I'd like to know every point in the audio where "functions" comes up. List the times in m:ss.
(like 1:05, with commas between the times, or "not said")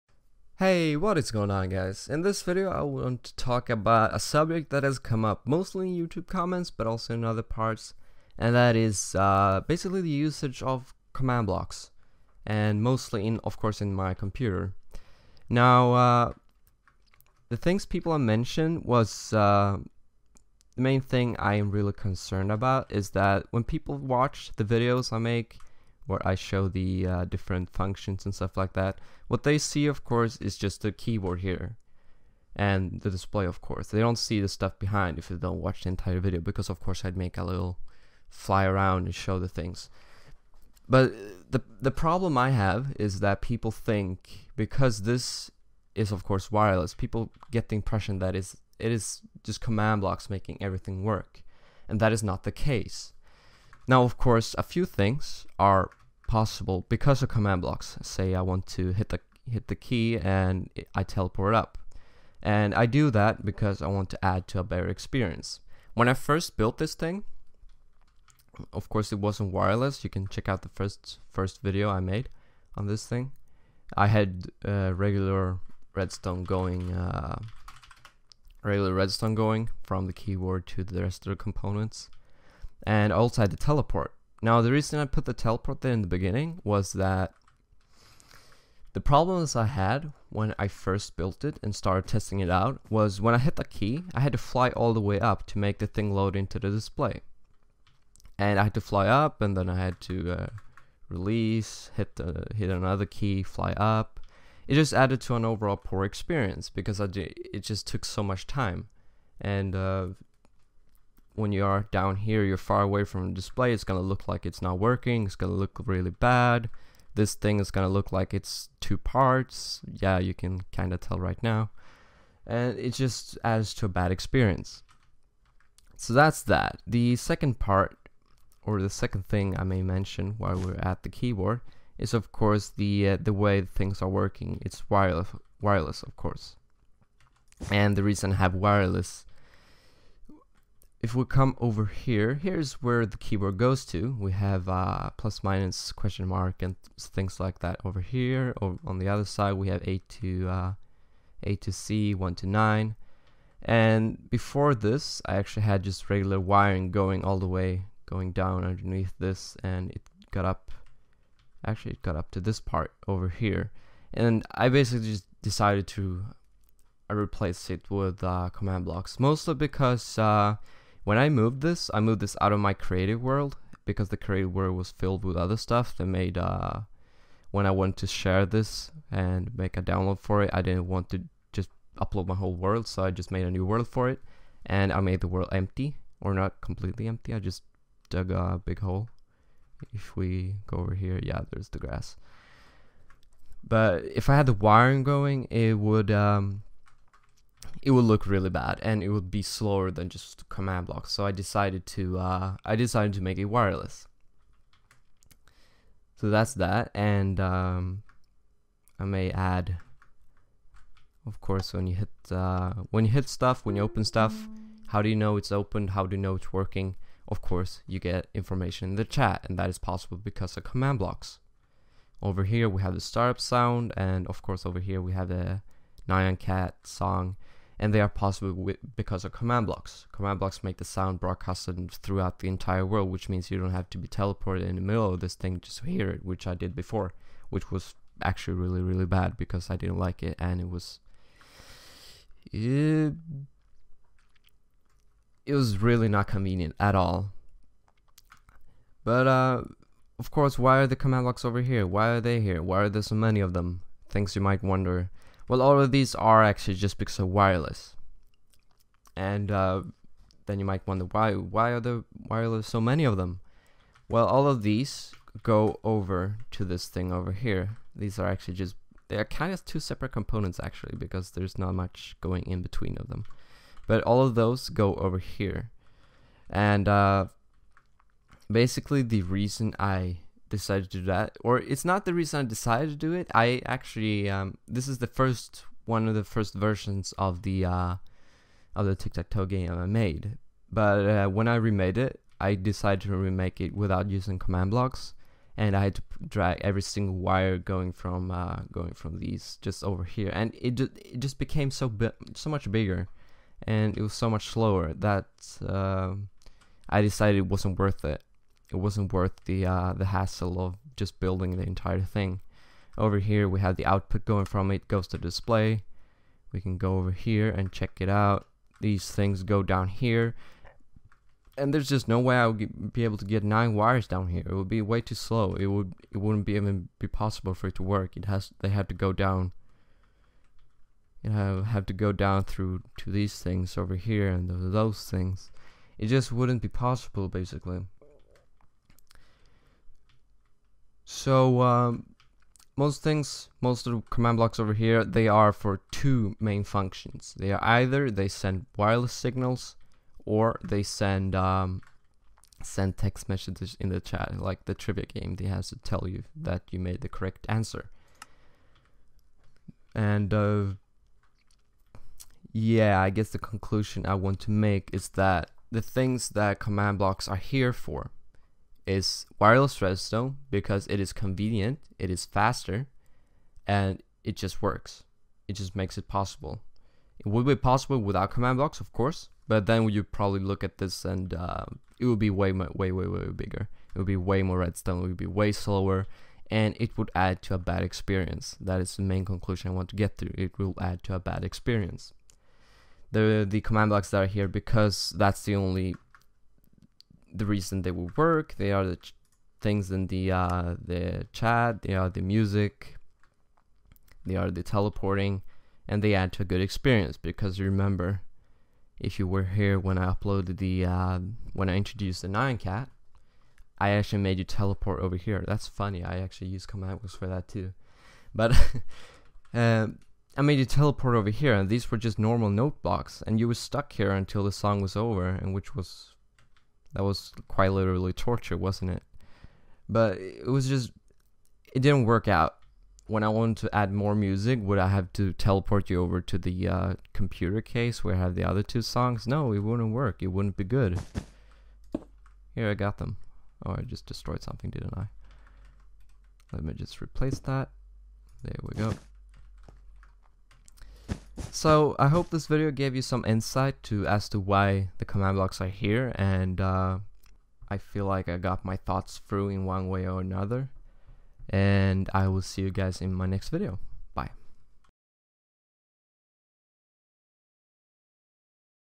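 0:27, 5:46.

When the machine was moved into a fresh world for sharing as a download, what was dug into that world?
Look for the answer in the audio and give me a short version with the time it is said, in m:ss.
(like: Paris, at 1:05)
A big hole, at 3:08.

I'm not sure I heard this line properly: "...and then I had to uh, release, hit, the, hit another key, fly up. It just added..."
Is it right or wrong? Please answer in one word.
right.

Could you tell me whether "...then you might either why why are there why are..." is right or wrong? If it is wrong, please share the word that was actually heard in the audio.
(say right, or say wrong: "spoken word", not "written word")
wrong: "wonder", not "either".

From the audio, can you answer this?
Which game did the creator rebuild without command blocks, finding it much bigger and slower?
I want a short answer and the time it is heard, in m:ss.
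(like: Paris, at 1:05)
Tic tac toe, at 4:48.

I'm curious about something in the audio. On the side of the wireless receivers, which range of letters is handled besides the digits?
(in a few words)
A to C.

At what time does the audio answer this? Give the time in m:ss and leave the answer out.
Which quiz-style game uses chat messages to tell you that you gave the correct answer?
5:54.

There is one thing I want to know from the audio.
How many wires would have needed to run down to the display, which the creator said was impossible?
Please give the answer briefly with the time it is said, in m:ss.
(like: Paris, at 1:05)
9, at 5:23.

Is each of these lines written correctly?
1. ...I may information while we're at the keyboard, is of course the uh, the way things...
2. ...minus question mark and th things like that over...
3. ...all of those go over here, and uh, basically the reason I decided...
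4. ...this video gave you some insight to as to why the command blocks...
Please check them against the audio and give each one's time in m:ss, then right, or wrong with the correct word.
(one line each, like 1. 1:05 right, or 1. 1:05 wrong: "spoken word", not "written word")
1. 2:09 wrong: "mention", not "information"
2. 2:25 right
3. 4:34 right
4. 7:32 right.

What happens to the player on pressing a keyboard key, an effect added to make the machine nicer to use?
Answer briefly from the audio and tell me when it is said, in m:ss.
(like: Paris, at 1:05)
Teleport up, at 1:00.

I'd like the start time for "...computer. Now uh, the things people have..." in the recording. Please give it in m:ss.
0:14.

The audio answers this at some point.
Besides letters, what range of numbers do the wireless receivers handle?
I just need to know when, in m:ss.
2:32.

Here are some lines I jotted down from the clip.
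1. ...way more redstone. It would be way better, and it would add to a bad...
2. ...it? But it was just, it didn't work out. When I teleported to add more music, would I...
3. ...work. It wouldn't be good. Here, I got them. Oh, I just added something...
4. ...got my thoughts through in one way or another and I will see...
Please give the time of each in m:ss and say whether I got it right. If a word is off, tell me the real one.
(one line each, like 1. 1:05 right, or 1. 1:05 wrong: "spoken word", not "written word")
1. 6:24 wrong: "slower", not "better"
2. 7:08 wrong: "wanted", not "teleported"
3. 7:19 wrong: "destroyed", not "added"
4. 7:38 right.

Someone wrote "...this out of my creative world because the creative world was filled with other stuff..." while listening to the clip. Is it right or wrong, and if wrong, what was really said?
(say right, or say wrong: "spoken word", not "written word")
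right.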